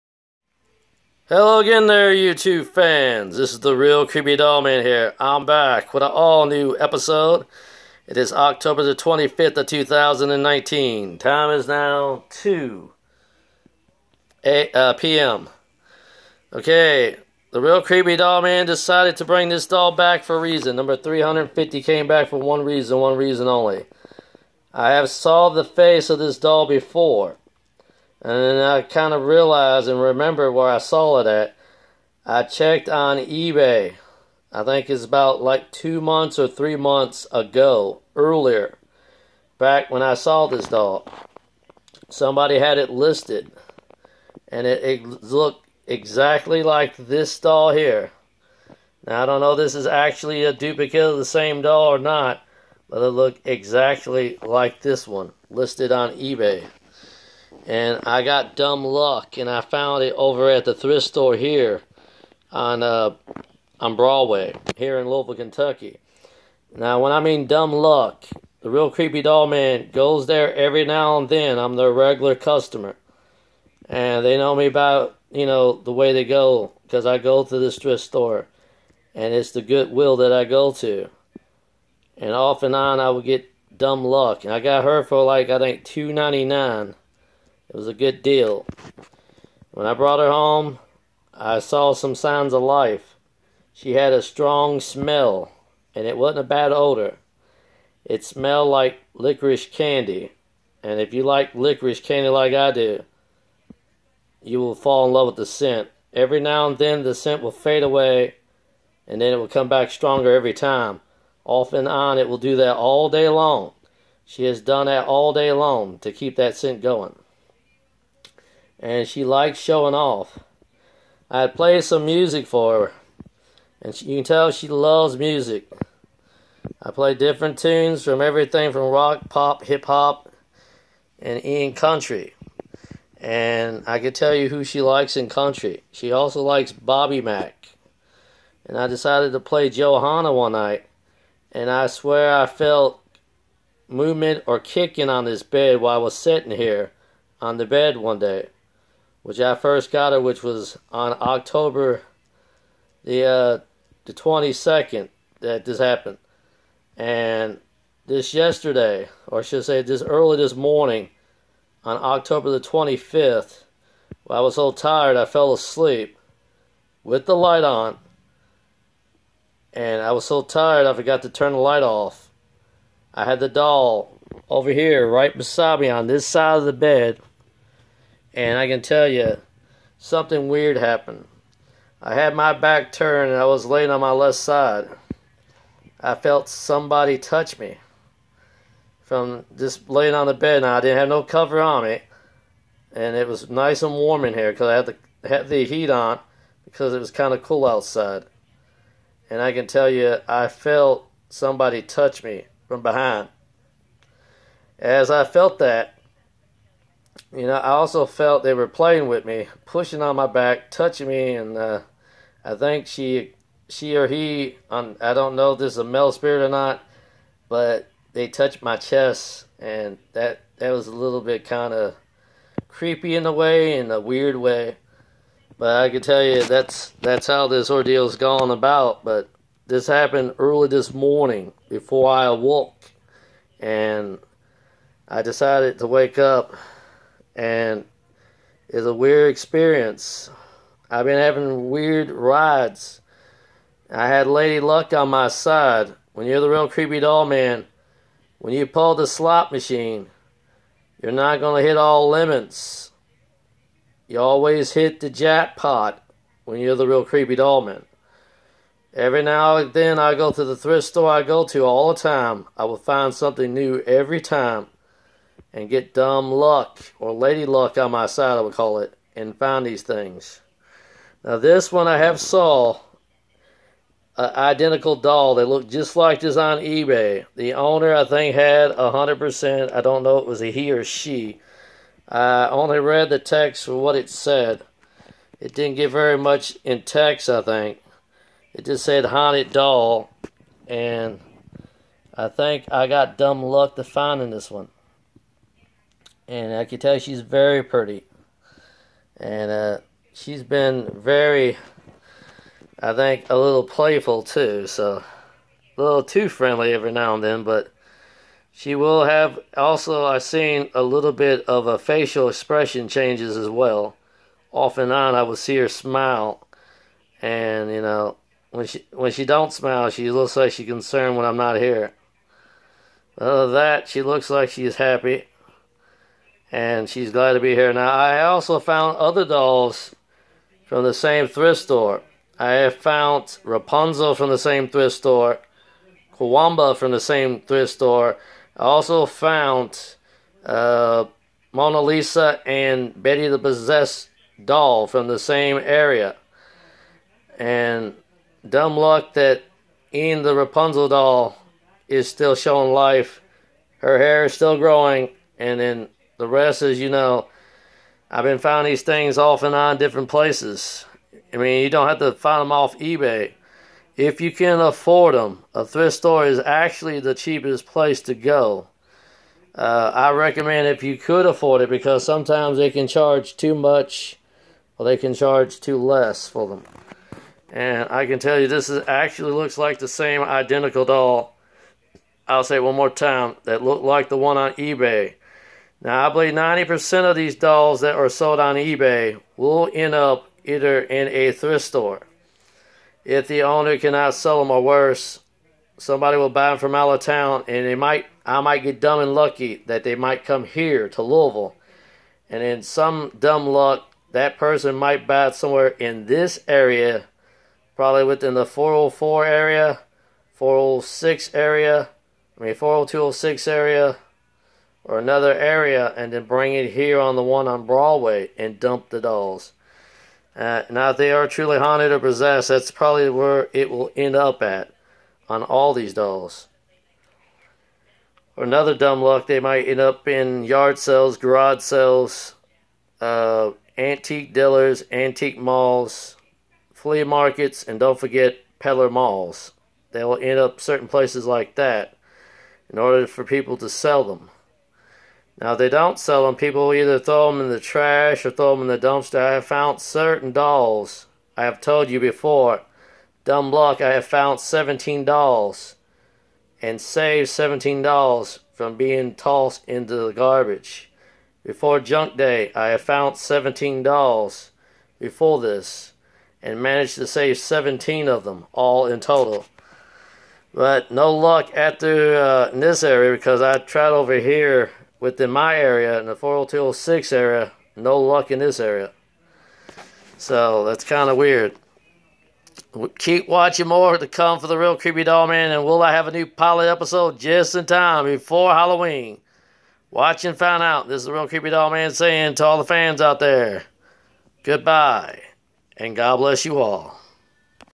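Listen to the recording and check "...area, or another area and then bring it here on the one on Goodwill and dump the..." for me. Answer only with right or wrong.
wrong.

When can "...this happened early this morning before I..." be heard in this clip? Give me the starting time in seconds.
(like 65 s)
229 s.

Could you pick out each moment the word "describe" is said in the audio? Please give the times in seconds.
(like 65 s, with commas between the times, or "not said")
not said.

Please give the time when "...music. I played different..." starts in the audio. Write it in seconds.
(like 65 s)
125 s.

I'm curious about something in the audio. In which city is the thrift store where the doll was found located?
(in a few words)
Louisville, Kentucky.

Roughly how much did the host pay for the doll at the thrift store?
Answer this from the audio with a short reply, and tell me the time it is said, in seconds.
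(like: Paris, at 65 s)
$2.99, at 85 s.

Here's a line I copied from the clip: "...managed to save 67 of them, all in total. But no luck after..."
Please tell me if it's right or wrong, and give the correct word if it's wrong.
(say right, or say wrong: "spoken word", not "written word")
wrong: "17", not "67".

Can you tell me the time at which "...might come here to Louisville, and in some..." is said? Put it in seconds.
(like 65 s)
399 s.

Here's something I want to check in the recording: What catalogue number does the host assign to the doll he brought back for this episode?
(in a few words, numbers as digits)
350.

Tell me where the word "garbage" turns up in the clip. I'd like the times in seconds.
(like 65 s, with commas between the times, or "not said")
460 s.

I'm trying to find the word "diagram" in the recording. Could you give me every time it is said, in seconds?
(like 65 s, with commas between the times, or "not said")
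not said.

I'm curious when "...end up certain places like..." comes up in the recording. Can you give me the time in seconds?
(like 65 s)
440 s.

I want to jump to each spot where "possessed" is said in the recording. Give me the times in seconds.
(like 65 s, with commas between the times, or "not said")
343 s, 421 s.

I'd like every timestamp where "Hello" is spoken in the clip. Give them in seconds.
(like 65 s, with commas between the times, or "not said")
1 s.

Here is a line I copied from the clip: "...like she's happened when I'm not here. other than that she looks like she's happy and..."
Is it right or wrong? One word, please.
wrong.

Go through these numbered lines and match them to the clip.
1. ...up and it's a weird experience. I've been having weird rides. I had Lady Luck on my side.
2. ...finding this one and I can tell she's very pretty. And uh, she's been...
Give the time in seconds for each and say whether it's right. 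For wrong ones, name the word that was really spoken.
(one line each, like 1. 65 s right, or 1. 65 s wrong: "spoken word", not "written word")
1. 236 s right
2. 293 s right.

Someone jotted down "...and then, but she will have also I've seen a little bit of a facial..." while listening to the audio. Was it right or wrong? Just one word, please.
right.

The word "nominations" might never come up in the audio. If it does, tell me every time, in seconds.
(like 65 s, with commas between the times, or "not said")
not said.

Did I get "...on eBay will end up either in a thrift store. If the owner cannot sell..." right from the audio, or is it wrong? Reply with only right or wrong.
right.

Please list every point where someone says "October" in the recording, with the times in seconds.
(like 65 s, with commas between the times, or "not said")
8 s, 151 s, 162 s.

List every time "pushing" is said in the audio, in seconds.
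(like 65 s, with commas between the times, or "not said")
209 s.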